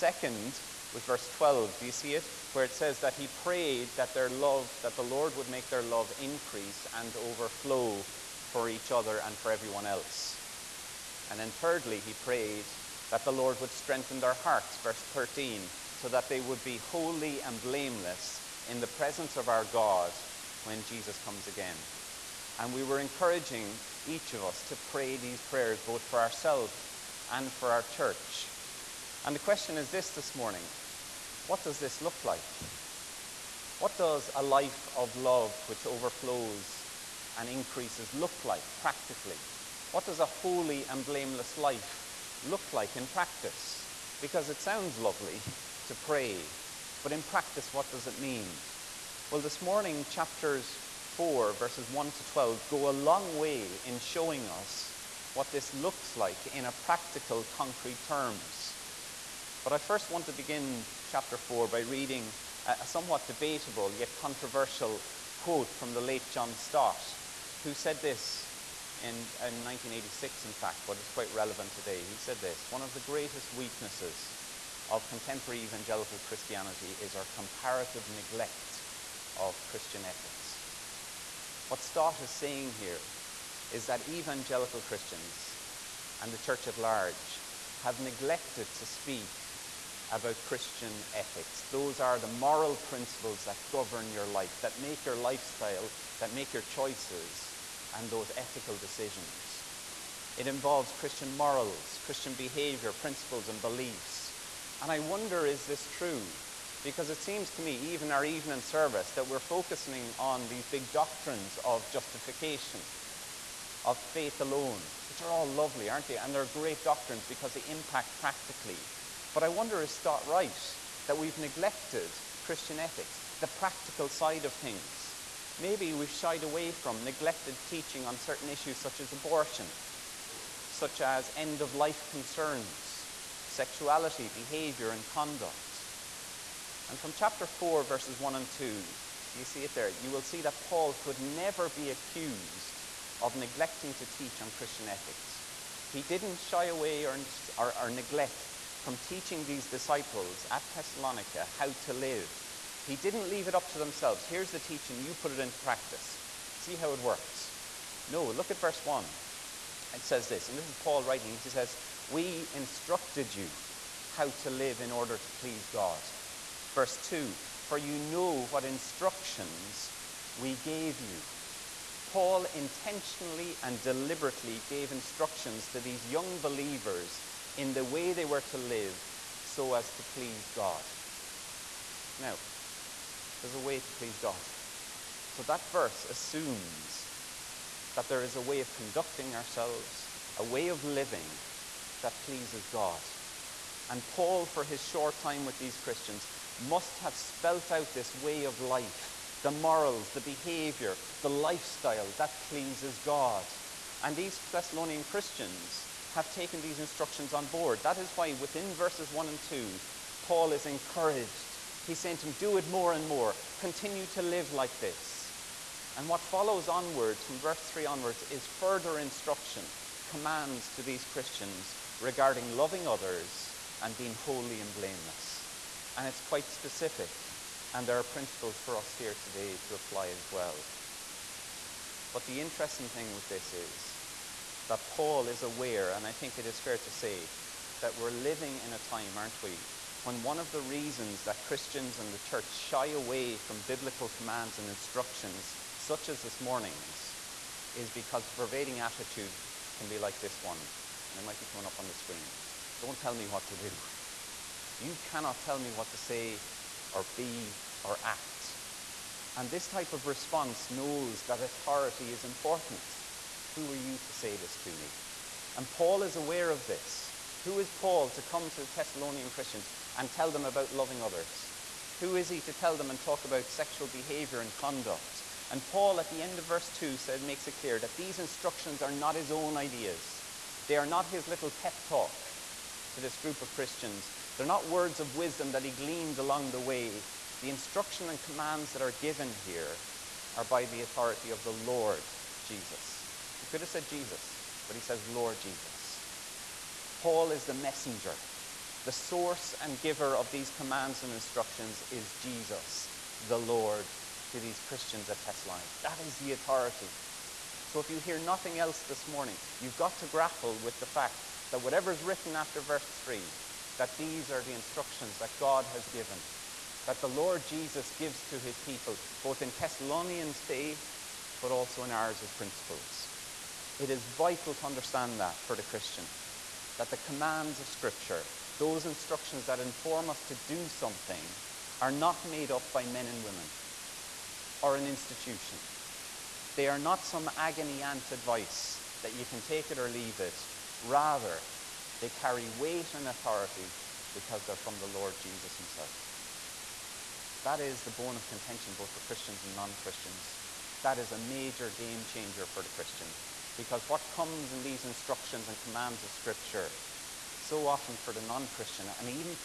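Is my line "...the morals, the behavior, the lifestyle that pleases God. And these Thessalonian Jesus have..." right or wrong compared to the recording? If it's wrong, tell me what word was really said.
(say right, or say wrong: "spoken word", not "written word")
wrong: "Christians", not "Jesus".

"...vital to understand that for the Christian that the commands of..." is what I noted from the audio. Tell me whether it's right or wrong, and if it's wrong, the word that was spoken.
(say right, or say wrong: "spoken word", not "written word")
right.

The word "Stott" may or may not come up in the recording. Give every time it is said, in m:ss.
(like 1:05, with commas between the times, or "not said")
1:06, 1:21.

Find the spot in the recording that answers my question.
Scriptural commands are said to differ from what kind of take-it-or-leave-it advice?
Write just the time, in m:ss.
5:37.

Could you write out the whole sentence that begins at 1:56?
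And they're great doctrines because they impact practically.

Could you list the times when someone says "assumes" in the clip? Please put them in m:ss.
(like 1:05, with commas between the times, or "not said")
3:06.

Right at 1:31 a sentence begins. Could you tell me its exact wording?
Those are the moral principles that govern your life, that make your lifestyle, that make your choices and those ethical decisions.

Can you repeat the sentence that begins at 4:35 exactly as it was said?
And Paul, at the end of verse 2, says, makes it clear that these instructions are not his own ideas.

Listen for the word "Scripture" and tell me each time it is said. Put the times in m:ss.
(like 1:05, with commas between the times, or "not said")
5:27, 5:56.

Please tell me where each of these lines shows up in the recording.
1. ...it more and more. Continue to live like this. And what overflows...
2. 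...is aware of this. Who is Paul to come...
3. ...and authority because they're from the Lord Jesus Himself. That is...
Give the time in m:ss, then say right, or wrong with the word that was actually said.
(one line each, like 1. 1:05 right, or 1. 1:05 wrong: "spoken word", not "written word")
1. 3:32 wrong: "follows", not "overflows"
2. 4:26 right
3. 5:42 right.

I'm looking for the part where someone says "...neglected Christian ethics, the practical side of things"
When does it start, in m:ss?
2:01.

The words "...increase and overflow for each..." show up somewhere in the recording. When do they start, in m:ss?
0:06.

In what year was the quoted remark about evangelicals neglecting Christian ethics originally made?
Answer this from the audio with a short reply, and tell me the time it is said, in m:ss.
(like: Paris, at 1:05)
1986, at 1:09.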